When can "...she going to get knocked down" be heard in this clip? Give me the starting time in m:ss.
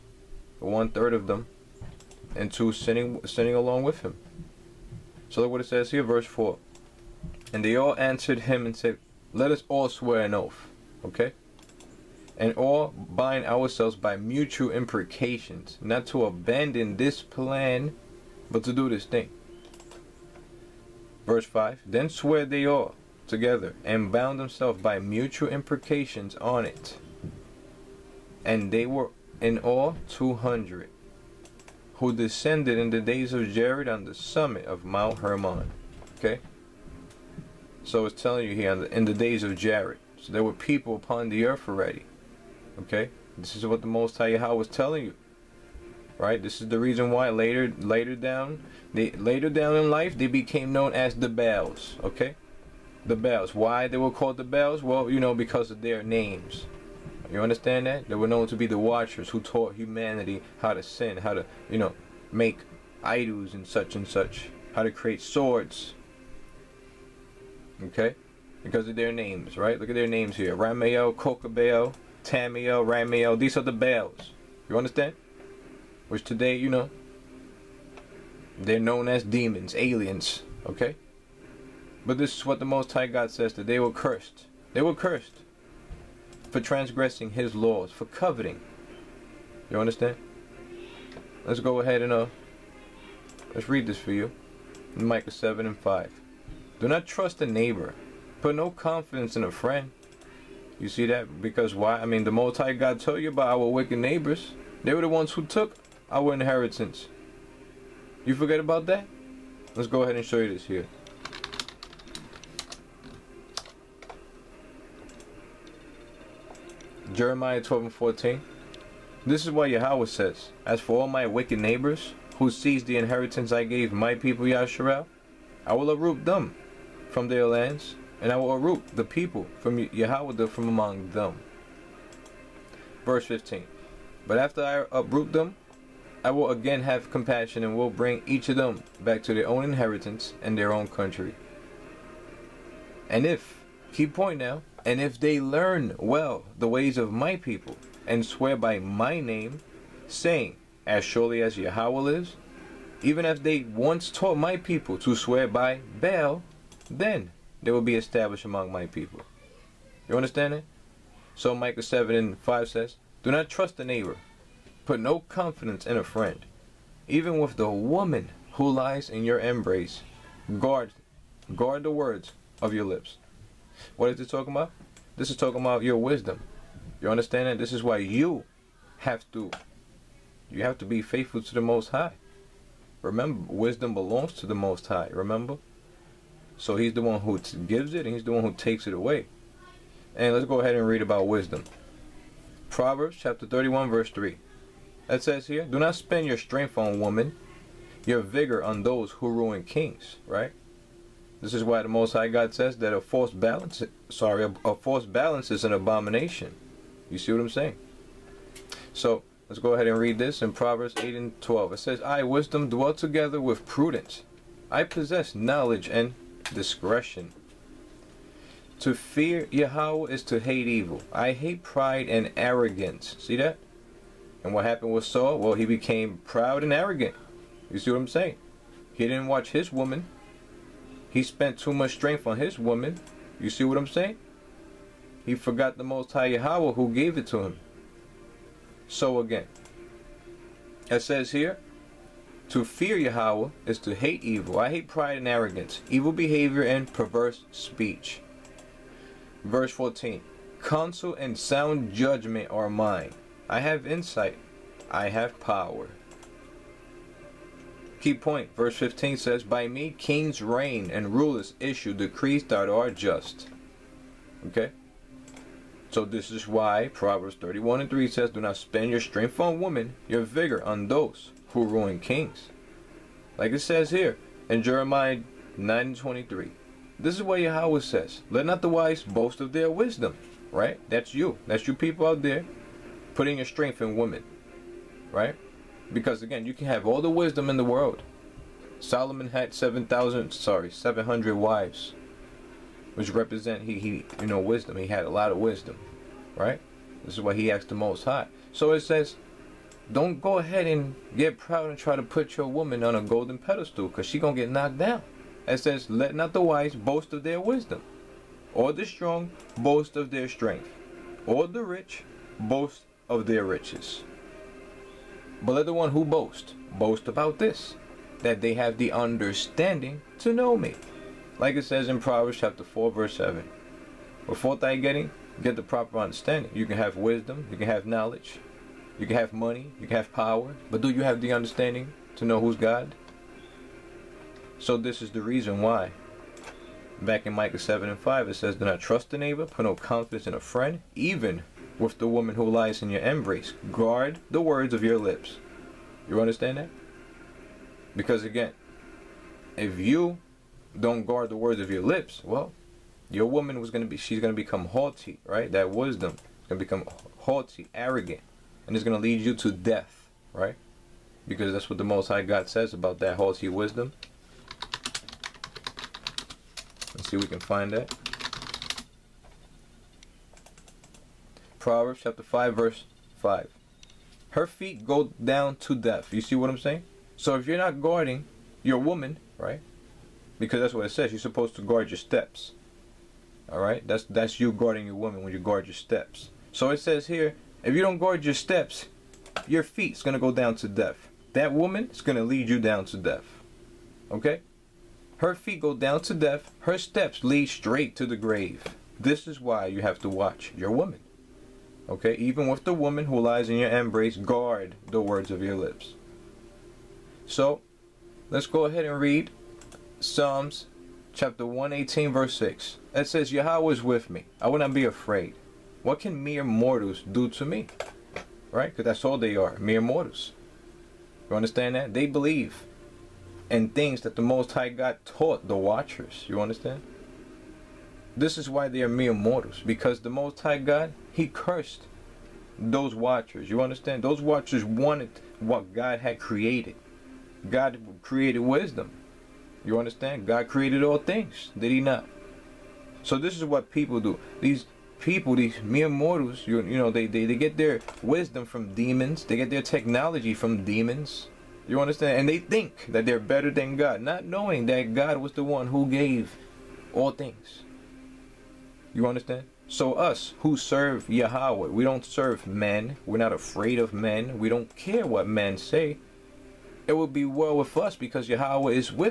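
5:04.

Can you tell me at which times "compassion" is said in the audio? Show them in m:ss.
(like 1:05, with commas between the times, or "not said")
2:17.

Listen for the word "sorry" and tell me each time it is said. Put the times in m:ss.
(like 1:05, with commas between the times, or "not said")
3:24, 4:50.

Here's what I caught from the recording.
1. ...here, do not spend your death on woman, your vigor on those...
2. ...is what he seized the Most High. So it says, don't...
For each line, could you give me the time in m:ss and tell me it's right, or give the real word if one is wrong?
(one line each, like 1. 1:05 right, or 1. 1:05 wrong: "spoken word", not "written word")
1. 3:15 wrong: "strength", not "death"
2. 4:57 wrong: "asked", not "seized".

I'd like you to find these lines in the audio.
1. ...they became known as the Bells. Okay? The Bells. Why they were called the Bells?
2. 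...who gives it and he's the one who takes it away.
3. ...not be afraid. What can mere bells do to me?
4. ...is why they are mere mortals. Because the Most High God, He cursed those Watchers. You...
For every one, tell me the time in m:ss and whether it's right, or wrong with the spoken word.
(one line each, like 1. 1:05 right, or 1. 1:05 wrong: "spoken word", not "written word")
1. 0:50 right
2. 3:07 right
3. 6:54 wrong: "mortals", not "bells"
4. 7:08 right.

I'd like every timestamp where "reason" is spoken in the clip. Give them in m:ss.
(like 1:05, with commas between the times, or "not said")
0:46, 5:35.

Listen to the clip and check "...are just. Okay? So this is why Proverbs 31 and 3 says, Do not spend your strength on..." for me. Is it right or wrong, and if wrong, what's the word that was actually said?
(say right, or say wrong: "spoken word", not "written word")
right.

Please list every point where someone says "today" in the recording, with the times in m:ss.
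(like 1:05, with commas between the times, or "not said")
1:16.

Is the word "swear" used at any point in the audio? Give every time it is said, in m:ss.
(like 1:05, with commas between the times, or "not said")
0:09, 0:22, 2:28, 2:35.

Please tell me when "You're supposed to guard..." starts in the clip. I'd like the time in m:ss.
6:21.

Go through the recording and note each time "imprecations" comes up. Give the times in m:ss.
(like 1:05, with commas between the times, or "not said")
0:14, 0:25.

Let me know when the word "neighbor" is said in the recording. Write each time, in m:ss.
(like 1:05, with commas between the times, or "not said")
1:37, 1:43, 2:01, 2:43, 5:39.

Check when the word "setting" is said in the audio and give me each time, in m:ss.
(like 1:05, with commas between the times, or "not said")
not said.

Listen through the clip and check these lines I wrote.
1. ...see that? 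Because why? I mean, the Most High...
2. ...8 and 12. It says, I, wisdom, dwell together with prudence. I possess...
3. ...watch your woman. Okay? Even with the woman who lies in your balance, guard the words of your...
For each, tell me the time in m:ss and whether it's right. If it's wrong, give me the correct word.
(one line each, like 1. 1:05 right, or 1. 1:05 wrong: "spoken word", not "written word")
1. 1:40 right
2. 3:30 right
3. 6:40 wrong: "embrace", not "balance".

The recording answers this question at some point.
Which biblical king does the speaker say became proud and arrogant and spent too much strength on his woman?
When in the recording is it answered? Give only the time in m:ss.
3:45.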